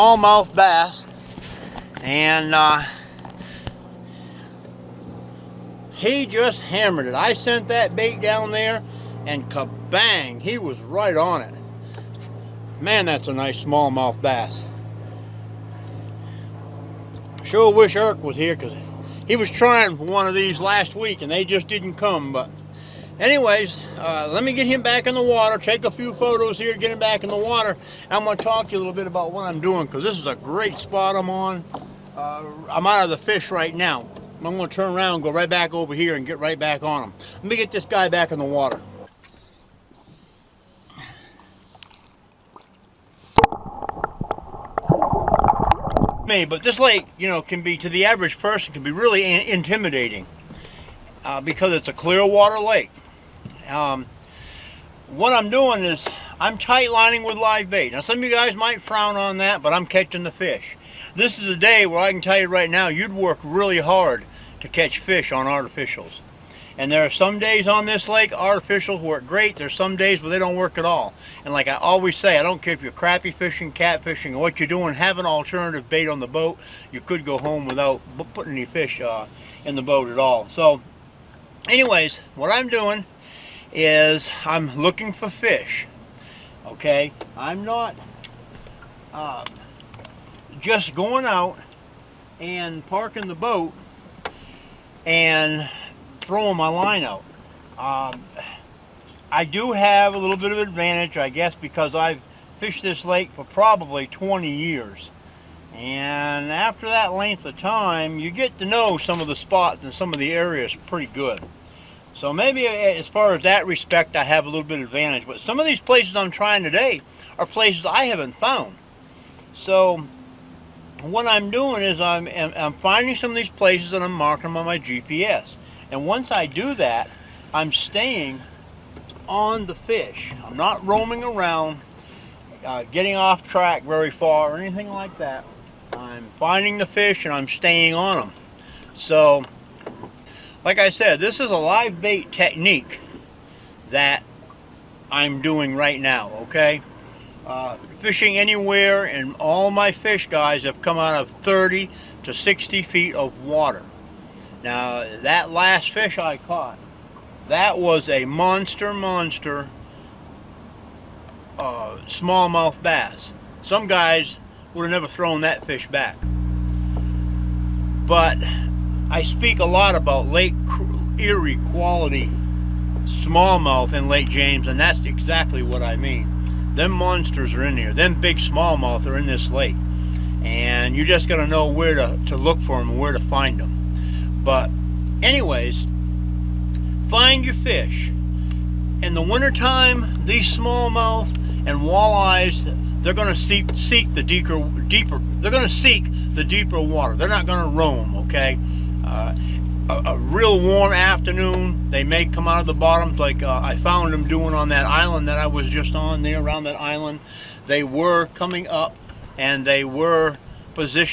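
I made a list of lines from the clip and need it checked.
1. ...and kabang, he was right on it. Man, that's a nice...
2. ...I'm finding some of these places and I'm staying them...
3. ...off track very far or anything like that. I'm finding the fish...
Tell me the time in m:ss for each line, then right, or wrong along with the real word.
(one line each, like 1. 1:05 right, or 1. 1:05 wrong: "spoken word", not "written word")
1. 0:09 right
2. 2:02 wrong: "marking", not "staying"
3. 2:13 right.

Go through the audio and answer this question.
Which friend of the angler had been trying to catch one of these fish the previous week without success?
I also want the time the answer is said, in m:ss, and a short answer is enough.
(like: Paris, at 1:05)
Eric, at 0:17.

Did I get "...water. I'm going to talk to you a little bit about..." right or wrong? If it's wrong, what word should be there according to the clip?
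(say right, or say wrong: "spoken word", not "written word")
right.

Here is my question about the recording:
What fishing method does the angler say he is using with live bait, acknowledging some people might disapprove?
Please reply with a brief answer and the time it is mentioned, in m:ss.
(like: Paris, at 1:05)
Tight lining, at 0:56.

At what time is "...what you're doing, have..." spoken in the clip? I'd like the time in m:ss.
1:14.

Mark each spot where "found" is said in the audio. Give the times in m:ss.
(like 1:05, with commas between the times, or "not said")
1:58, 3:23.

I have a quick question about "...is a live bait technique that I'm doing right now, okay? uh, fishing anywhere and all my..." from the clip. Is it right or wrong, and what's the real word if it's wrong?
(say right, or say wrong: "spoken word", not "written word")
right.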